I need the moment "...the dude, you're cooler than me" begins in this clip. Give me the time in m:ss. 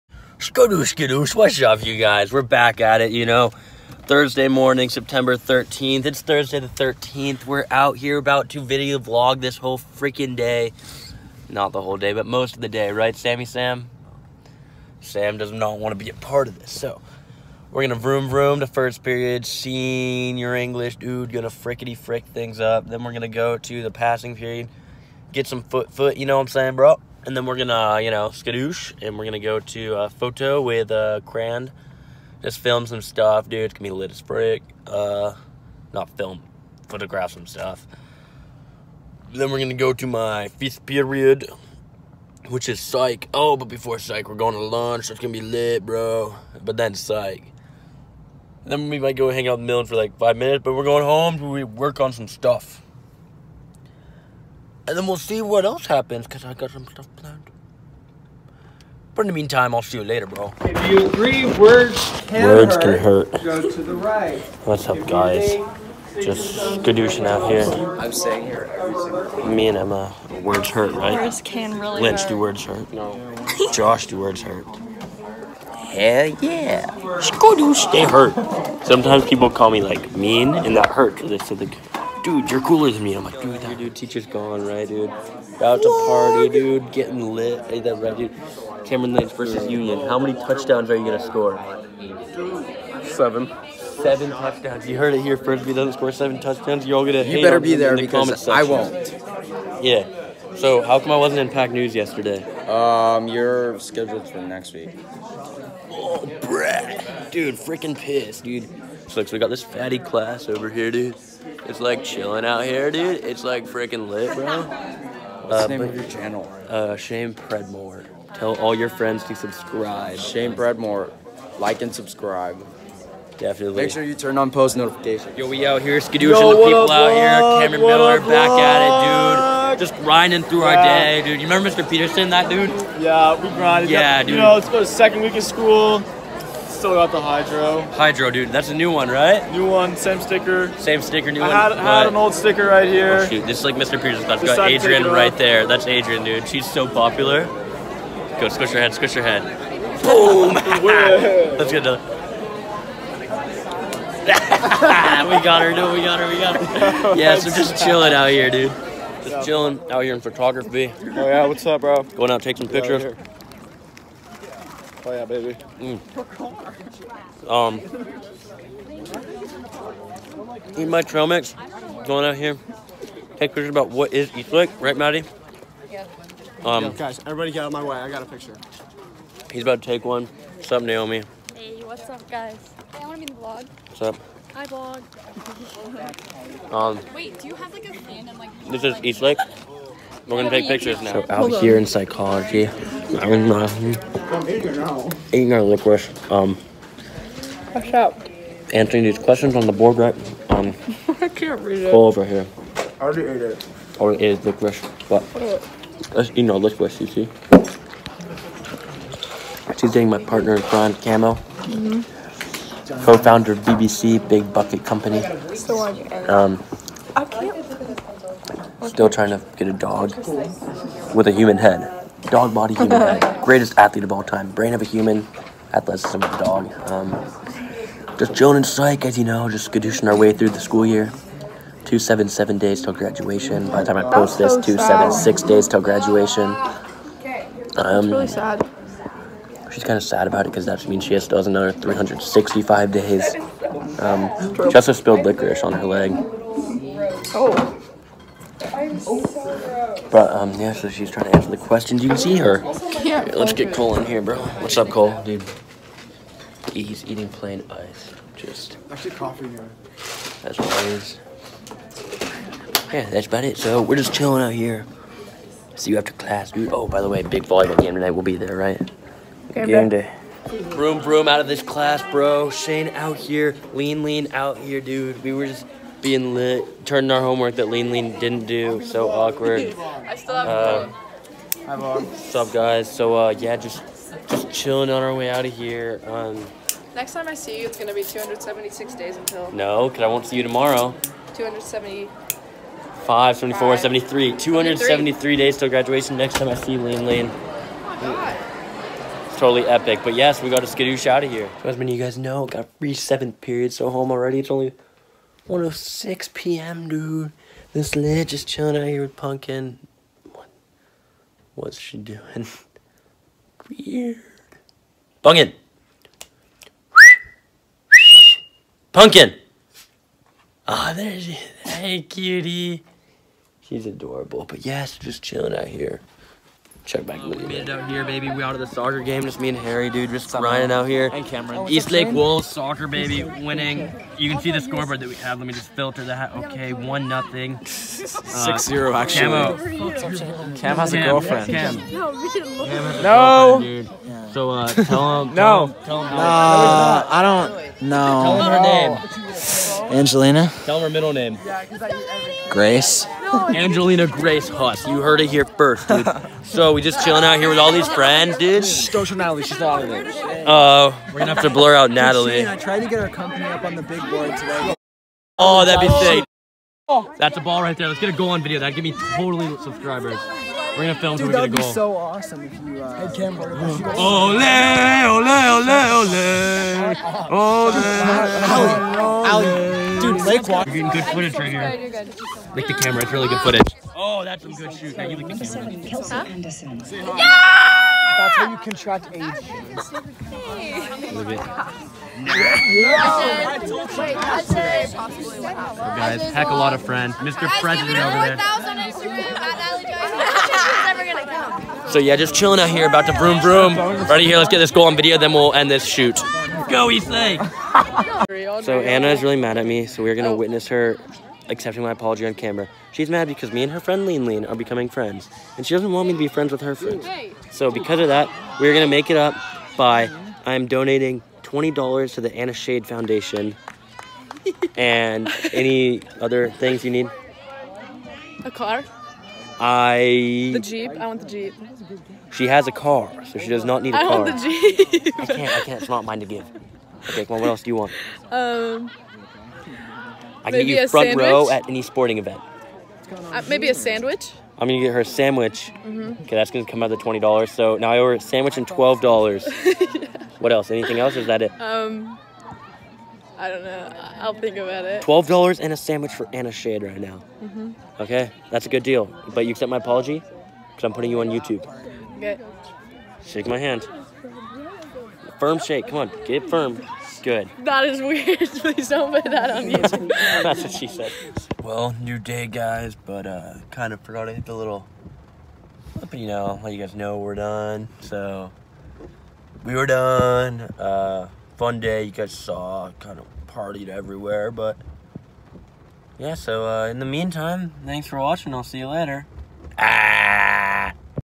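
1:21.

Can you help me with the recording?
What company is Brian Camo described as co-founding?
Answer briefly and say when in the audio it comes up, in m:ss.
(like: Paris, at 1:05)
Big Bucket Company, at 3:34.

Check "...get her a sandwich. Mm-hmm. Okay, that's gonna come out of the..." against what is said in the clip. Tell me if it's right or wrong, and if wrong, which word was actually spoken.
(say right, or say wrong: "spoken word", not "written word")
right.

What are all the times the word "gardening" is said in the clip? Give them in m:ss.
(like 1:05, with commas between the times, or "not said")
not said.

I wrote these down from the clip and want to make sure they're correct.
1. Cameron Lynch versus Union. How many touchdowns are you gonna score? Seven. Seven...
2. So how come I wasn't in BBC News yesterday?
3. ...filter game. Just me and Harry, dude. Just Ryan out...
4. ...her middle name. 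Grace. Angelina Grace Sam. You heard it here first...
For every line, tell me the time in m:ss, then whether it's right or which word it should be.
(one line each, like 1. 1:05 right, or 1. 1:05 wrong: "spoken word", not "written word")
1. 1:28 right
2. 1:40 wrong: "Pack", not "BBC"
3. 5:28 wrong: "soccer", not "filter"
4. 5:50 wrong: "Huss", not "Sam".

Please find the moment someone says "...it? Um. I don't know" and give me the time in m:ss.
7:31.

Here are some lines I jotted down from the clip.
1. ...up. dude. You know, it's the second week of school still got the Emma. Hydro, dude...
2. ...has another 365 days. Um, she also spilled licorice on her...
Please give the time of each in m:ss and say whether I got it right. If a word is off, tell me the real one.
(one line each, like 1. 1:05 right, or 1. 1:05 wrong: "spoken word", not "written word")
1. 2:14 wrong: "Hydro", not "Emma"
2. 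4:01 right.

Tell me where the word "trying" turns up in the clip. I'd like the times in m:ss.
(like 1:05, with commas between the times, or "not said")
3:39, 4:11.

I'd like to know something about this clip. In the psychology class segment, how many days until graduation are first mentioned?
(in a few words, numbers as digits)
277.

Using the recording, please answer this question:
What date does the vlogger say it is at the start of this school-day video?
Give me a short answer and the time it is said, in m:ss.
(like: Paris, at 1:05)
September 13th, at 0:04.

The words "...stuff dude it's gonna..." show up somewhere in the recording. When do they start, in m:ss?
0:33.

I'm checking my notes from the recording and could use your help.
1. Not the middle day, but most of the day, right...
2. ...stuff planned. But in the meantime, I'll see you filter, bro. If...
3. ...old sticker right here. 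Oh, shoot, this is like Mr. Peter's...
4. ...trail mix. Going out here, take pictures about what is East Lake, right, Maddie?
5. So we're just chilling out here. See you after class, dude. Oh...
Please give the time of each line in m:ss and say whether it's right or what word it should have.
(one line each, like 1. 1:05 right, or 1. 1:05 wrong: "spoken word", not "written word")
1. 0:11 wrong: "whole", not "middle"
2. 0:56 wrong: "later", not "filter"
3. 2:22 right
4. 2:51 right
5. 4:23 right.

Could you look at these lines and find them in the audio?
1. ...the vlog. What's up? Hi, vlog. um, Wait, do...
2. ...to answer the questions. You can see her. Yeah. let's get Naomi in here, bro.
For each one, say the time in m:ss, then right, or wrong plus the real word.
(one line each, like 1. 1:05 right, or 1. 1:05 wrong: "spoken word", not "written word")
1. 3:03 right
2. 4:11 wrong: "Cole", not "Naomi".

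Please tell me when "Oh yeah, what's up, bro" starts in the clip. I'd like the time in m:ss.
2:40.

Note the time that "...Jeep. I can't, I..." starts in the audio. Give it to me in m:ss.
7:15.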